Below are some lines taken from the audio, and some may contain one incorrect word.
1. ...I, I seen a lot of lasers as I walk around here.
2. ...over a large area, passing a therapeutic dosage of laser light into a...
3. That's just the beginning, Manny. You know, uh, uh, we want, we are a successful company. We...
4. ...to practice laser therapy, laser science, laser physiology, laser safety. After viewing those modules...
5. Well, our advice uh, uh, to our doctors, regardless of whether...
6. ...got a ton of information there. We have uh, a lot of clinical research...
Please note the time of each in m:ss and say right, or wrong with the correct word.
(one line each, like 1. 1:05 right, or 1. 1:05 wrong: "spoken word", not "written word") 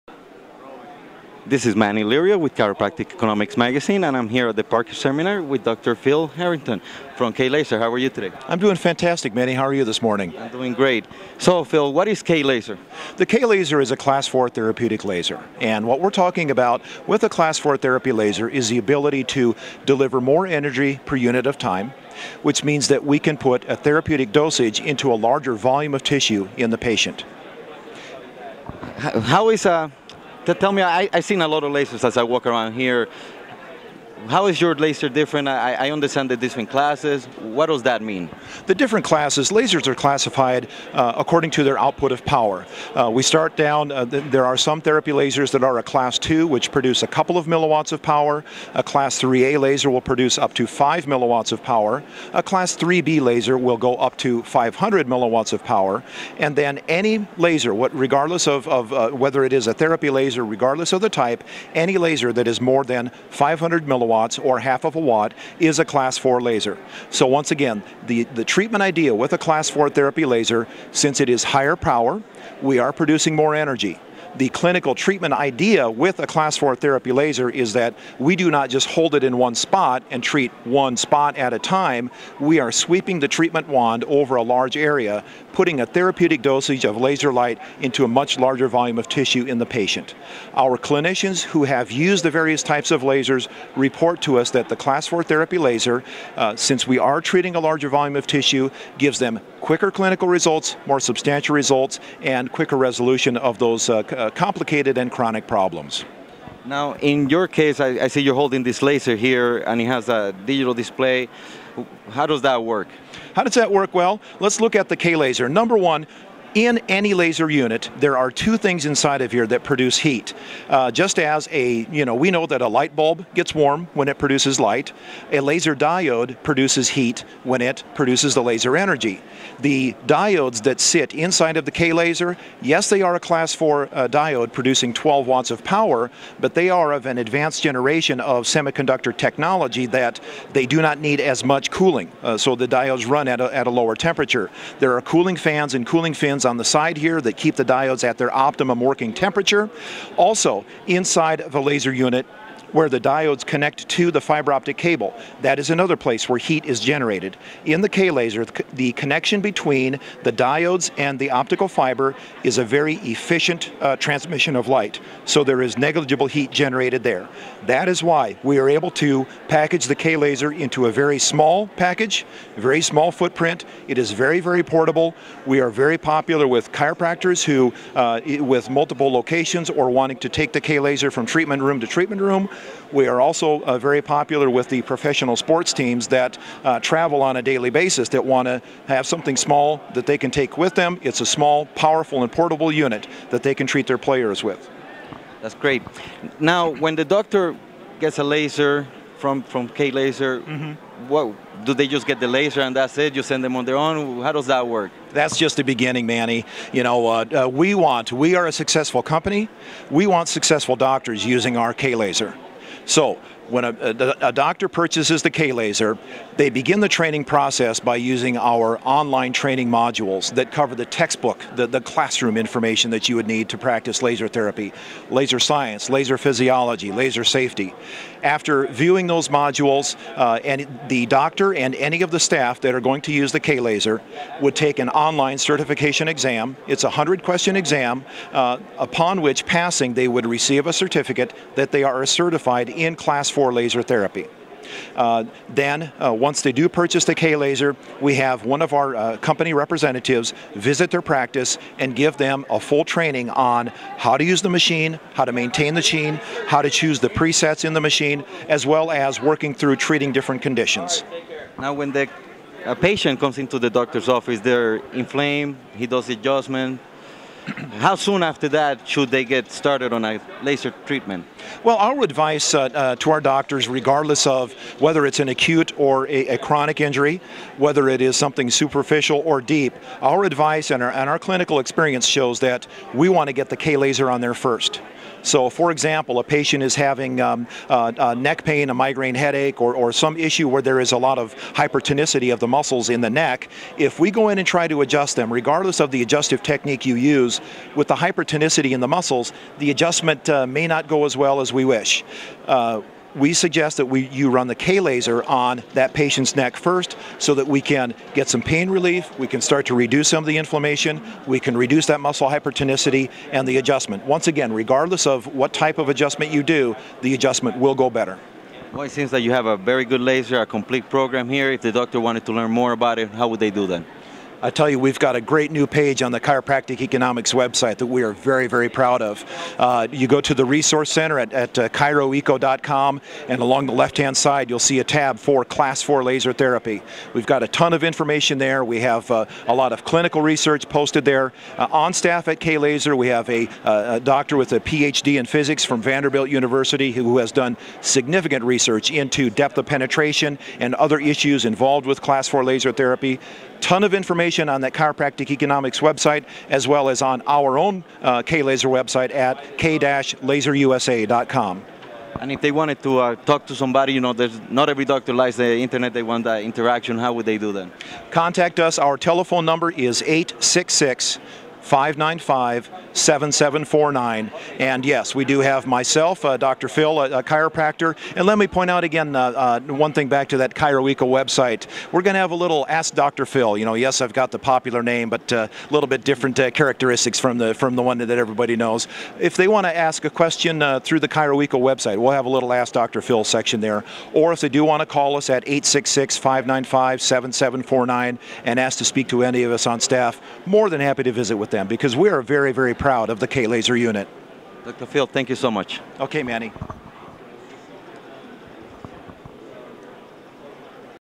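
1. 0:30 right
2. 1:24 wrong: "putting", not "passing"
3. 3:25 right
4. 3:43 right
5. 4:31 right
6. 5:37 right.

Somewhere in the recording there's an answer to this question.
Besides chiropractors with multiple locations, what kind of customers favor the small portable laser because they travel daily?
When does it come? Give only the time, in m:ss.
3:04.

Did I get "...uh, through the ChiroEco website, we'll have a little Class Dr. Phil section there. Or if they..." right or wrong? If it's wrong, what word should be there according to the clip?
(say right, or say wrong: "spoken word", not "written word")
wrong: "Ask", not "Class".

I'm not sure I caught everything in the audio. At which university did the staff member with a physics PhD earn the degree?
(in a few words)
Vanderbilt University.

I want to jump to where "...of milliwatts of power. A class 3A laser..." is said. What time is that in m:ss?
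0:47.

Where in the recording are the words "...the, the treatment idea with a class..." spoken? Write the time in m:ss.
1:08.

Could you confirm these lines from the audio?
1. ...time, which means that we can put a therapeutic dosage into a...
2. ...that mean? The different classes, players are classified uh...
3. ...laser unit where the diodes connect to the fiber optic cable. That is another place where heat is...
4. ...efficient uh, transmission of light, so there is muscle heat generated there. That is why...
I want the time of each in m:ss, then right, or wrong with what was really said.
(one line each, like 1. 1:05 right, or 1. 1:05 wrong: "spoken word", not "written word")
1. 0:21 right
2. 0:37 wrong: "lasers", not "players"
3. 2:31 right
4. 2:42 wrong: "negligible", not "muscle".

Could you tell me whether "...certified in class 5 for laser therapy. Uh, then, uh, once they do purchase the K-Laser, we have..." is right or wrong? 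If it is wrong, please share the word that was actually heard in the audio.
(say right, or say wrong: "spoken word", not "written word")
wrong: "4", not "5".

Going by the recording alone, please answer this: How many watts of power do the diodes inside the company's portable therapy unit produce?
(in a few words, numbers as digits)
12 watts.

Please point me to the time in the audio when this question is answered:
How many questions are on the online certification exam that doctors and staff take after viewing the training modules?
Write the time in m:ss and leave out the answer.
3:56.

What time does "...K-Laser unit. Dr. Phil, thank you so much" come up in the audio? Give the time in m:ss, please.
6:43.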